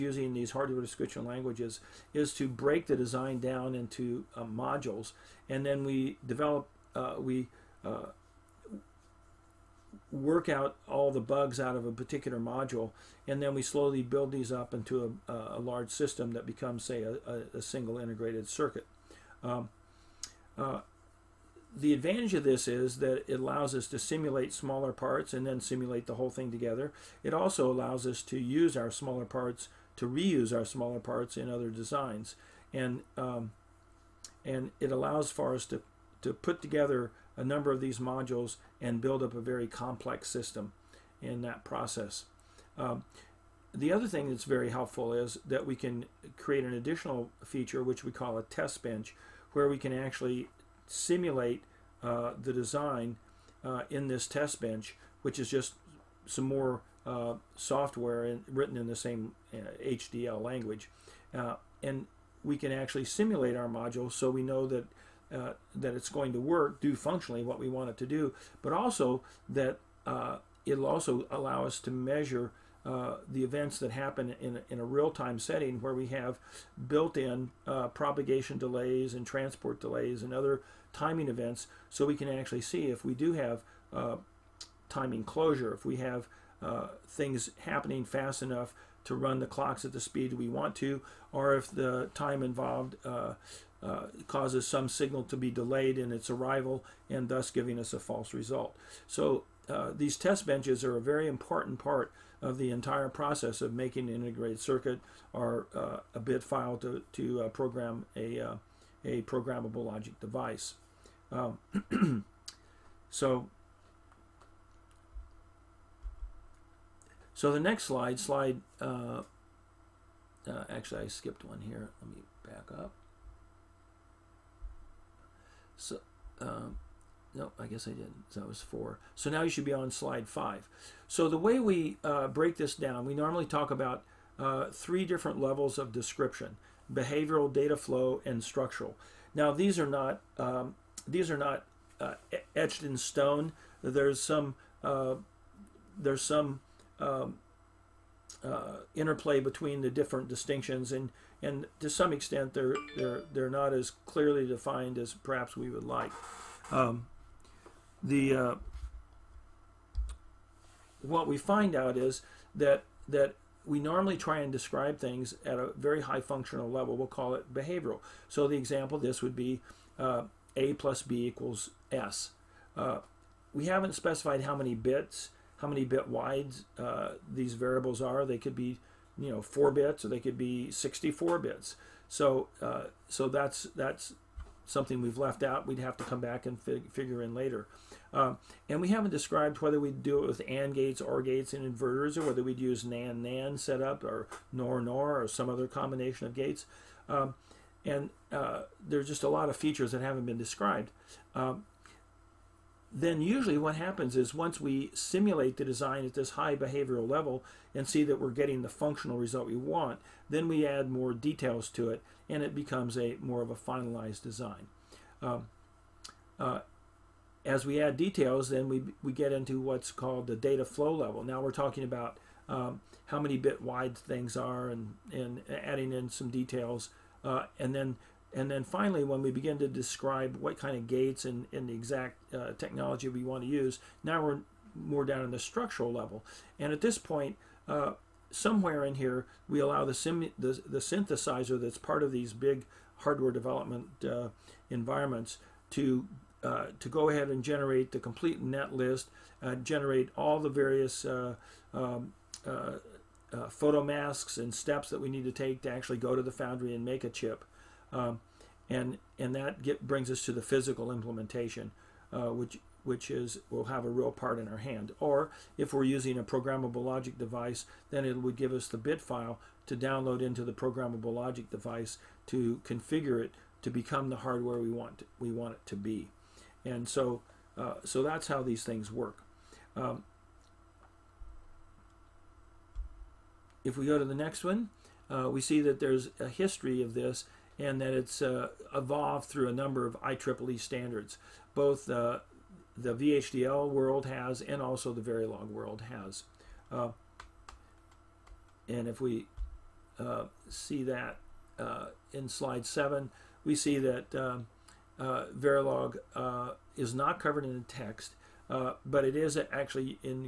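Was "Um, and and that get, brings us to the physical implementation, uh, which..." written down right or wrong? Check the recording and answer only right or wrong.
right.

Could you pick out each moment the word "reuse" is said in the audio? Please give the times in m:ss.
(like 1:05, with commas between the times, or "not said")
0:30.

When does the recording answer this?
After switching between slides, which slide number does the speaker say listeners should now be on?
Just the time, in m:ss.
2:09.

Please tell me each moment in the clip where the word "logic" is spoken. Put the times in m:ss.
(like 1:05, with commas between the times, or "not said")
1:49, 4:26, 4:31.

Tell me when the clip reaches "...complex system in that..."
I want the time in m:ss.
0:39.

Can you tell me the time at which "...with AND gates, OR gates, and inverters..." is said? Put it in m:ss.
3:10.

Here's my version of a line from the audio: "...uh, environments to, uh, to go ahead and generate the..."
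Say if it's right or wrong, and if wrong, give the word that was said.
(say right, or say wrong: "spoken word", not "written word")
right.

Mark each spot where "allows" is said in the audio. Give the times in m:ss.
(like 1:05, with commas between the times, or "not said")
0:23, 0:27, 0:34, 1:11, 3:59.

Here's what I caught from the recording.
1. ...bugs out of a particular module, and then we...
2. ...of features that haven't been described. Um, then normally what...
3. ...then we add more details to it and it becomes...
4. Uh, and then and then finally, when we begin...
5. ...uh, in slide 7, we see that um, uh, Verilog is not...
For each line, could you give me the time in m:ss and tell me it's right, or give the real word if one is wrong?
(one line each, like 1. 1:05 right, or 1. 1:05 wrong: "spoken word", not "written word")
1. 0:11 right
2. 3:19 wrong: "usually", not "normally"
3. 3:30 right
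4. 3:47 right
5. 5:01 right.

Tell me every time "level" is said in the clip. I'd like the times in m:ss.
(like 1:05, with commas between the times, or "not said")
2:15, 2:46, 3:27, 3:40, 3:55.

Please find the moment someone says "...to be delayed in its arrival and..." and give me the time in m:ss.
1:35.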